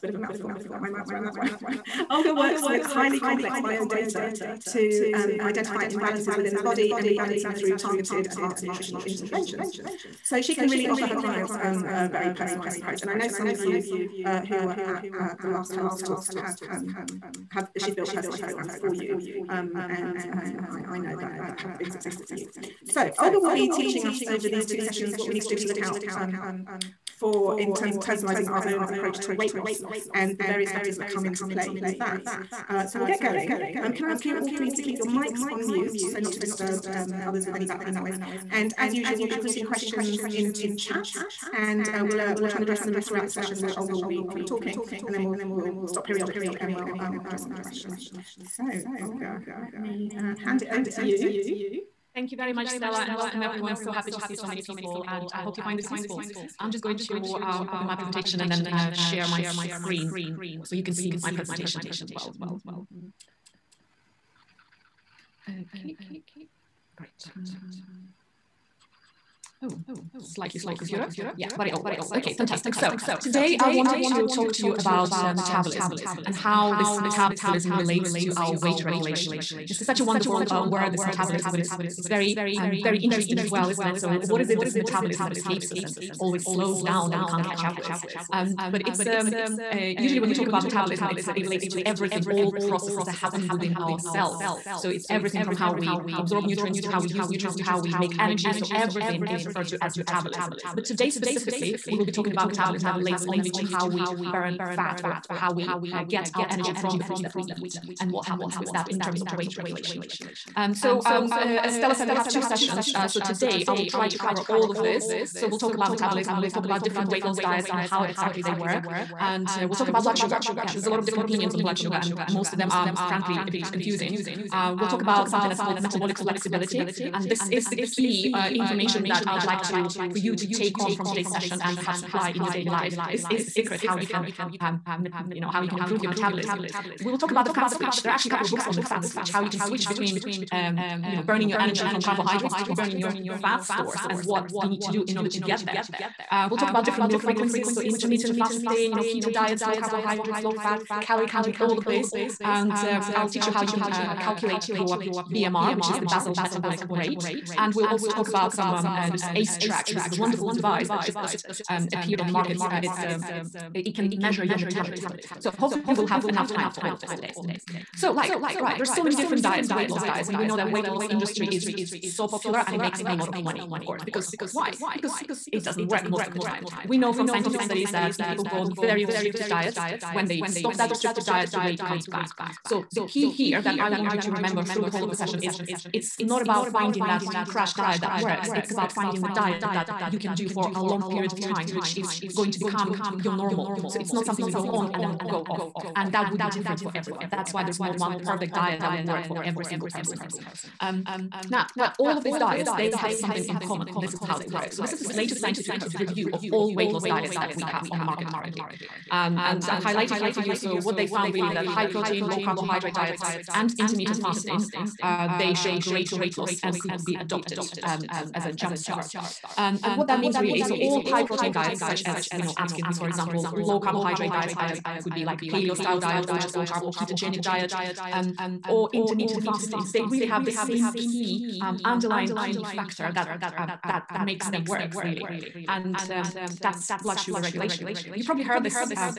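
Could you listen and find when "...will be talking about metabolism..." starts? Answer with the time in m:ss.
1:41.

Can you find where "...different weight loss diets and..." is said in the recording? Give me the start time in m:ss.
1:56.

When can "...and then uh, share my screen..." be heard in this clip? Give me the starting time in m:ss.
0:58.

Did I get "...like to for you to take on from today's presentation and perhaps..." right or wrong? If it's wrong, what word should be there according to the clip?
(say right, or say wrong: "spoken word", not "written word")
wrong: "session", not "presentation".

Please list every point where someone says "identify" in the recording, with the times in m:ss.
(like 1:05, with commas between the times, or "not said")
0:05.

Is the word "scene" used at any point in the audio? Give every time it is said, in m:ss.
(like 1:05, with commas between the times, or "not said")
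not said.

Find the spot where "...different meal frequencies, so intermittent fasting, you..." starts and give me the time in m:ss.
2:26.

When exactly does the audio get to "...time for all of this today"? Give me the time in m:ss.
2:46.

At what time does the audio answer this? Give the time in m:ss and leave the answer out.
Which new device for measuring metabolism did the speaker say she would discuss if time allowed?
2:39.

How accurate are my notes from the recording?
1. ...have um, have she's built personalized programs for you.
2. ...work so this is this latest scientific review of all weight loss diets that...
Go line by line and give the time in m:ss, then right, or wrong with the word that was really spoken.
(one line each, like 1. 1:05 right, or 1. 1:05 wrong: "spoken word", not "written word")
1. 0:16 right
2. 3:24 right.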